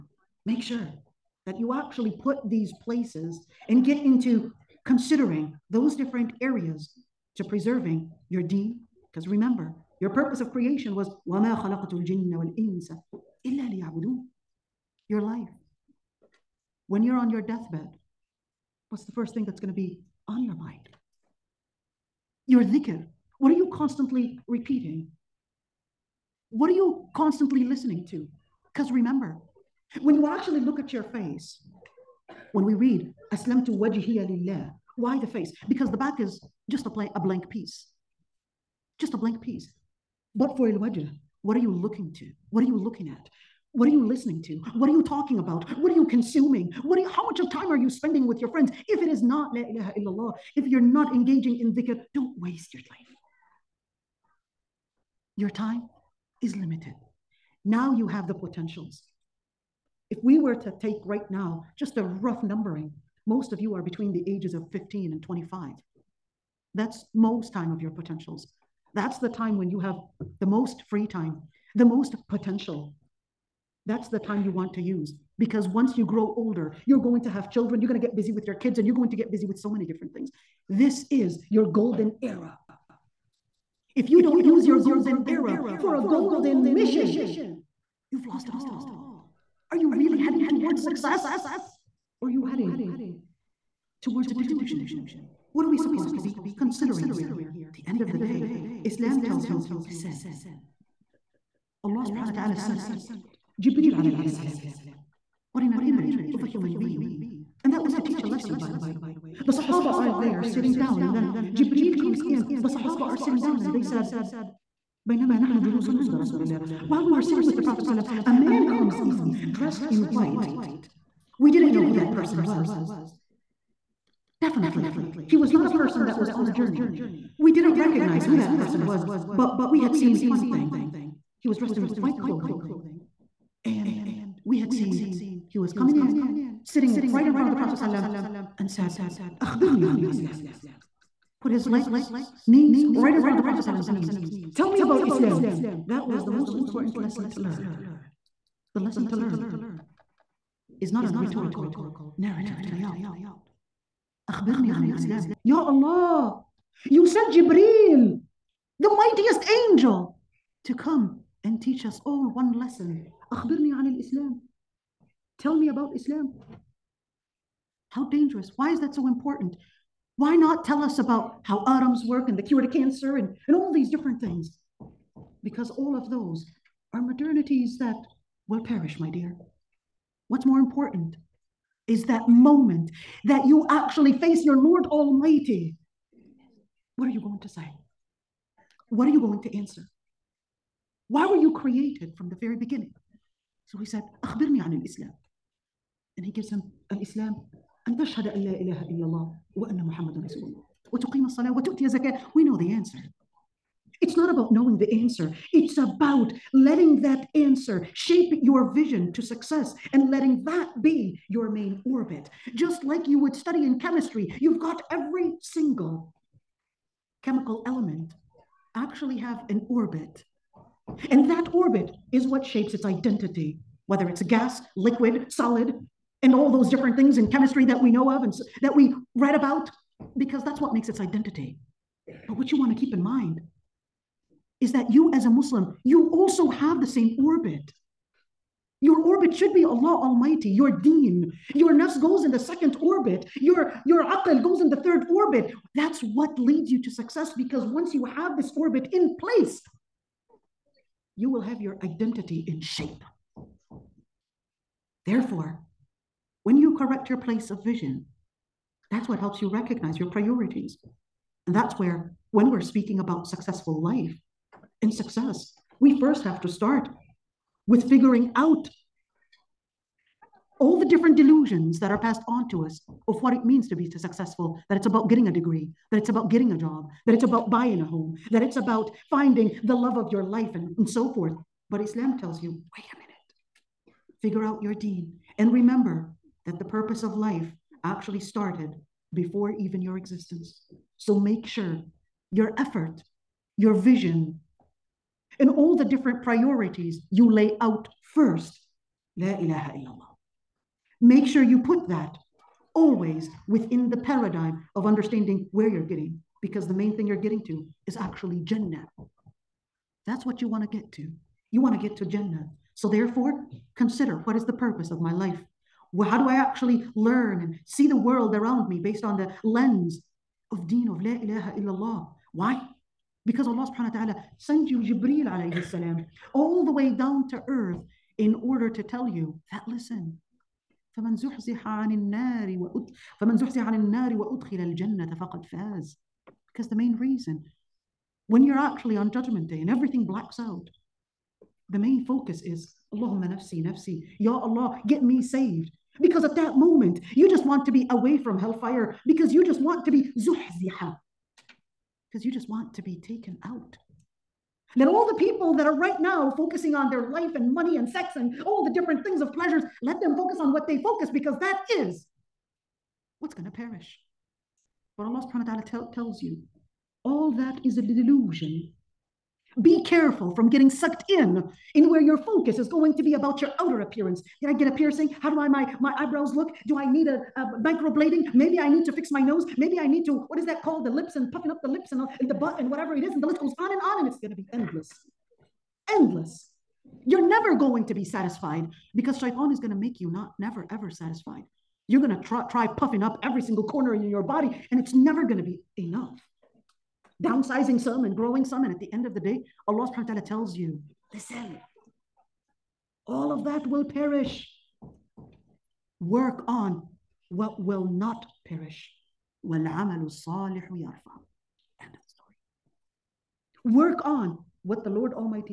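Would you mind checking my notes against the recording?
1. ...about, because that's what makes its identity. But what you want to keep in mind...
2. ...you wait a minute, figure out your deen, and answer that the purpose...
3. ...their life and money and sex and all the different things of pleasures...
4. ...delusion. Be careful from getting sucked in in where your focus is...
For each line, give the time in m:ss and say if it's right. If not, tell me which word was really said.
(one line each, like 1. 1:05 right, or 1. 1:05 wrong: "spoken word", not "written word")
1. 3:49 right
2. 4:42 wrong: "remember", not "answer"
3. 5:56 right
4. 6:07 right.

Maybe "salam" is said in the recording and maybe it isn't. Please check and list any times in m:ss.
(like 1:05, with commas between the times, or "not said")
1:44, 5:25.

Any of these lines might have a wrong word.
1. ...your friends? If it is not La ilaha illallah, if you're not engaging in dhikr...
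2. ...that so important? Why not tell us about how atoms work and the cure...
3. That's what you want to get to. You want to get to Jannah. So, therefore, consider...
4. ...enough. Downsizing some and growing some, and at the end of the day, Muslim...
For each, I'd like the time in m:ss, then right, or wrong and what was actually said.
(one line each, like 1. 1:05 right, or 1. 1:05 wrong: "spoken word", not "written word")
1. 0:48 right
2. 2:48 right
3. 5:10 right
4. 6:35 wrong: "Allah", not "Muslim".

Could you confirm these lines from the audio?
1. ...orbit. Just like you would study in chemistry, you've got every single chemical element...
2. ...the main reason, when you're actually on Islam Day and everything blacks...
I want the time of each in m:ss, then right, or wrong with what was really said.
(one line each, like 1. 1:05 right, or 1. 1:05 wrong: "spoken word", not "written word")
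1. 3:31 right
2. 5:36 wrong: "Judgment", not "Islam".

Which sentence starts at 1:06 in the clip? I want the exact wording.
That's most time of your potentials.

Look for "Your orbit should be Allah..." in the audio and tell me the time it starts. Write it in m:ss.
3:58.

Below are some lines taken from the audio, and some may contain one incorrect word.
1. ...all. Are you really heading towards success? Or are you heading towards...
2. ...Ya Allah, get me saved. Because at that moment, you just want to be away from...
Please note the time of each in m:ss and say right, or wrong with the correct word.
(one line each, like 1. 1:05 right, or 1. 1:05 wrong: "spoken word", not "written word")
1. 1:28 right
2. 5:44 right.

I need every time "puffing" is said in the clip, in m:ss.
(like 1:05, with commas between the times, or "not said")
6:21, 6:32.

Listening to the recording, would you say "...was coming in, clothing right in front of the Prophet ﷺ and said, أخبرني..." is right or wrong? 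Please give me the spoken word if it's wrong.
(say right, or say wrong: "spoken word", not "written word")
wrong: "sitting", not "clothing".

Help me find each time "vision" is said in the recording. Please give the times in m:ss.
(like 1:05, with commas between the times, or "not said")
3:28, 4:17, 4:53.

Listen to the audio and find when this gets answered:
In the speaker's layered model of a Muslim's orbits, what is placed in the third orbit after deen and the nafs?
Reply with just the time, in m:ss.
4:04.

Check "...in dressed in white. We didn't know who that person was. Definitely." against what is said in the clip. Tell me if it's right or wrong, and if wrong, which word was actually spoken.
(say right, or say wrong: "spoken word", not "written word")
right.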